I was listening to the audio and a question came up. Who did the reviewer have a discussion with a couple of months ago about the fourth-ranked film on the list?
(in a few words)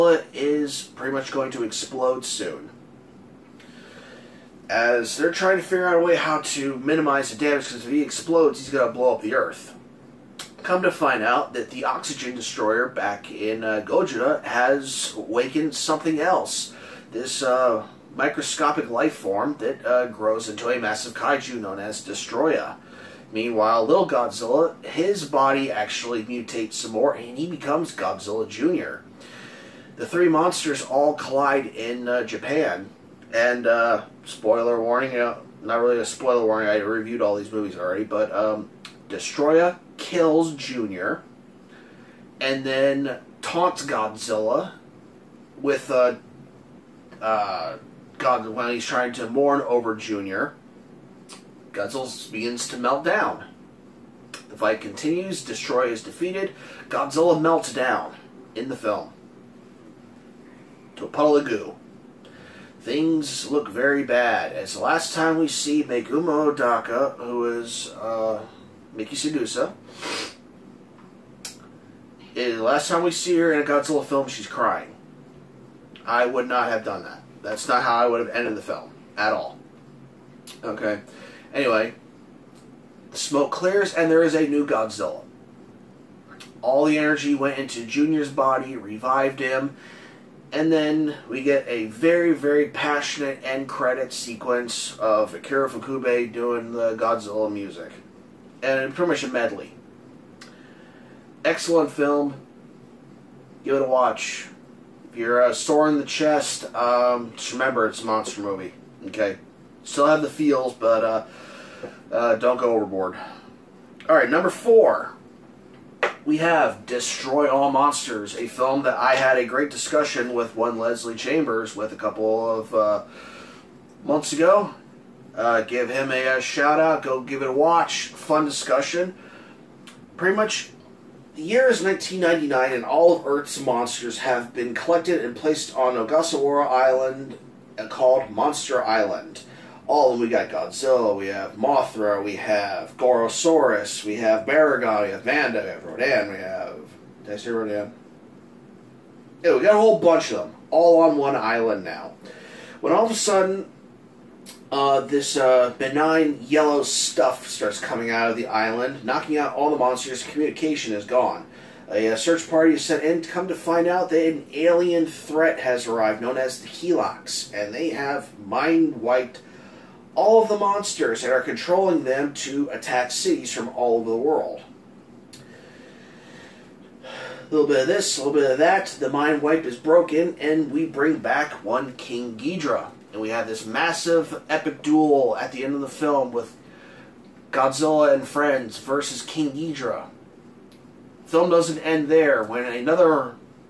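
Leslie Chambers.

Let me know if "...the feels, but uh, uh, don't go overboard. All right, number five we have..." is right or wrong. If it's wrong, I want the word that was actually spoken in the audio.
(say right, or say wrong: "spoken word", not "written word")
wrong: "four", not "five".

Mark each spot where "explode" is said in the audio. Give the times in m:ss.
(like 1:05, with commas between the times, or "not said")
0:01, 0:08.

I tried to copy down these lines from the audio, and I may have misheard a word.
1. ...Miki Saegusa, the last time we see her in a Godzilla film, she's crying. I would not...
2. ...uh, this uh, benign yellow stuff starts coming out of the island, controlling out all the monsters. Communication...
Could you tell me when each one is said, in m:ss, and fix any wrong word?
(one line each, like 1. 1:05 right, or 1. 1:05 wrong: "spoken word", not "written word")
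1. 1:08 right
2. 2:34 wrong: "knocking", not "controlling".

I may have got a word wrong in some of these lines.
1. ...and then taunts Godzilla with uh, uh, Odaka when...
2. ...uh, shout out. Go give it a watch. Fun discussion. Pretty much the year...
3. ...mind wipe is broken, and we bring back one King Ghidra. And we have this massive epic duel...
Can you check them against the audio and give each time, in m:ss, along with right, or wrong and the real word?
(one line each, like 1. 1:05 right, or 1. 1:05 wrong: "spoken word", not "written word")
1. 0:42 wrong: "God", not "Odaka"
2. 2:06 right
3. 2:59 right.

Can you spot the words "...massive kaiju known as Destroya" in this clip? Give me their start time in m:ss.
0:20.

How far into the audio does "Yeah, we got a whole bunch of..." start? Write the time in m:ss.
2:29.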